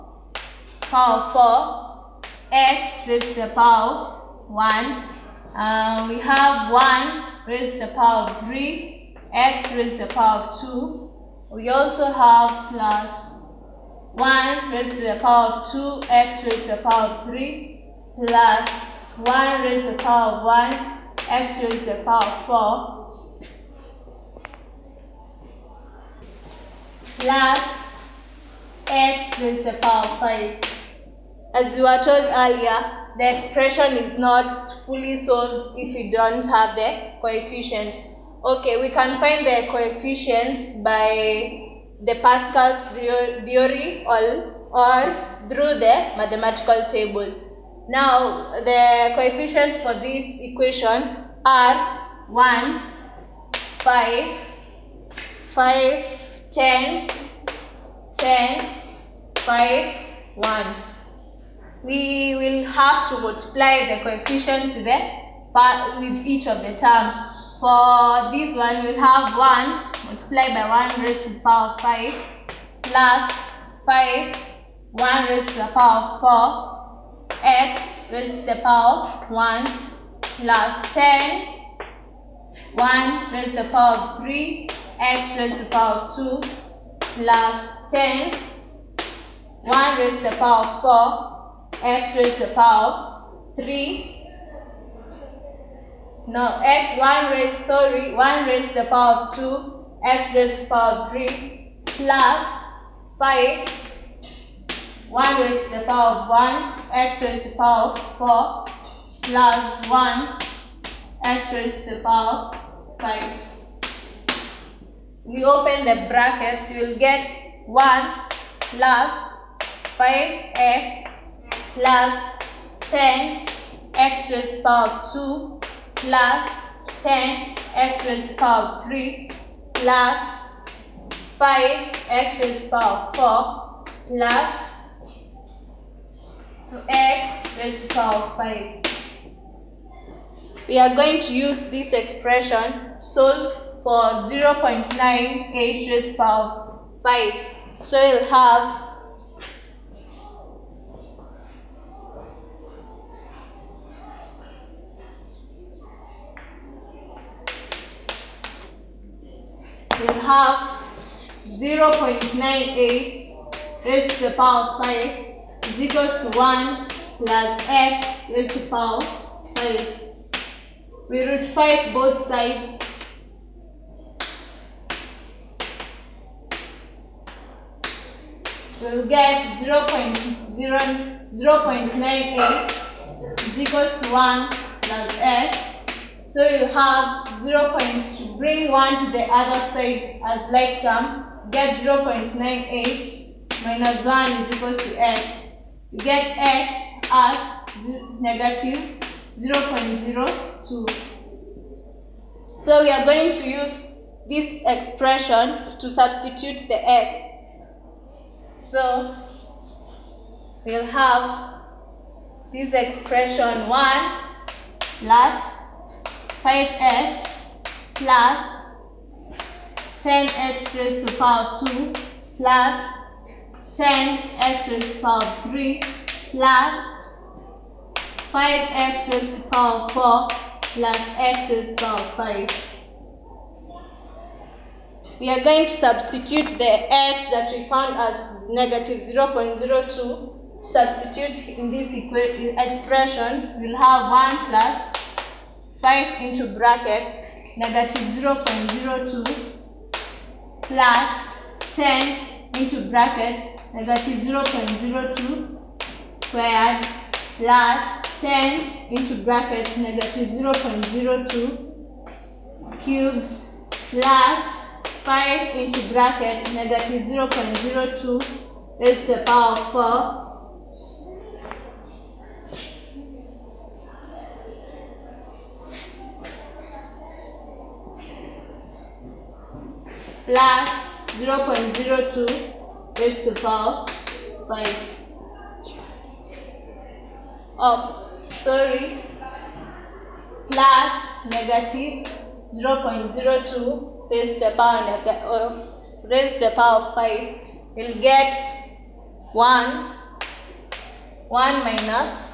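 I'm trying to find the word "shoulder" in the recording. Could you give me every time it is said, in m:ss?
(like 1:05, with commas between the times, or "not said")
not said.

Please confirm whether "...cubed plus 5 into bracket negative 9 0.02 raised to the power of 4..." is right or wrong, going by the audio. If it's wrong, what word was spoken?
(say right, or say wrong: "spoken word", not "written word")
wrong: "0", not "9".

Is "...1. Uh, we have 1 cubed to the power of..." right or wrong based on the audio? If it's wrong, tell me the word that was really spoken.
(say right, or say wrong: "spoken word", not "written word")
wrong: "raised", not "cubed".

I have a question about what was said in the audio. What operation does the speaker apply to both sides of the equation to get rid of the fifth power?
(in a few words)
root 5.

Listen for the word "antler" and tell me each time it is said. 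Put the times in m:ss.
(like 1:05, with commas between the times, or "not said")
not said.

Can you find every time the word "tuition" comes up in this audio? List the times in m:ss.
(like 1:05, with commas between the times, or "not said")
not said.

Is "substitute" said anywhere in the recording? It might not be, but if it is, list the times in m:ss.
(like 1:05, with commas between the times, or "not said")
3:25, 3:55, 4:00.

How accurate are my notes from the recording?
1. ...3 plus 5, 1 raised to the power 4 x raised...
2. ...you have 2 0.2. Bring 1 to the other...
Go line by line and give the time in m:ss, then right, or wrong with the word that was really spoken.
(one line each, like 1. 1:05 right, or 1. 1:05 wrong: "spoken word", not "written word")
1. 1:11 wrong: "5", not "3"
2. 3:06 wrong: "0", not "2".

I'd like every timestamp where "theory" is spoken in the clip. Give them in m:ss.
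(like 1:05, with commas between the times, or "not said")
0:42.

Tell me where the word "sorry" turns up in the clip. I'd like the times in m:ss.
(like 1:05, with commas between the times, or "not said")
1:37, 4:48.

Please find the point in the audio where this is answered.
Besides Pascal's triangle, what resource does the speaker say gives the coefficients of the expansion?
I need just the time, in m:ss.
0:46.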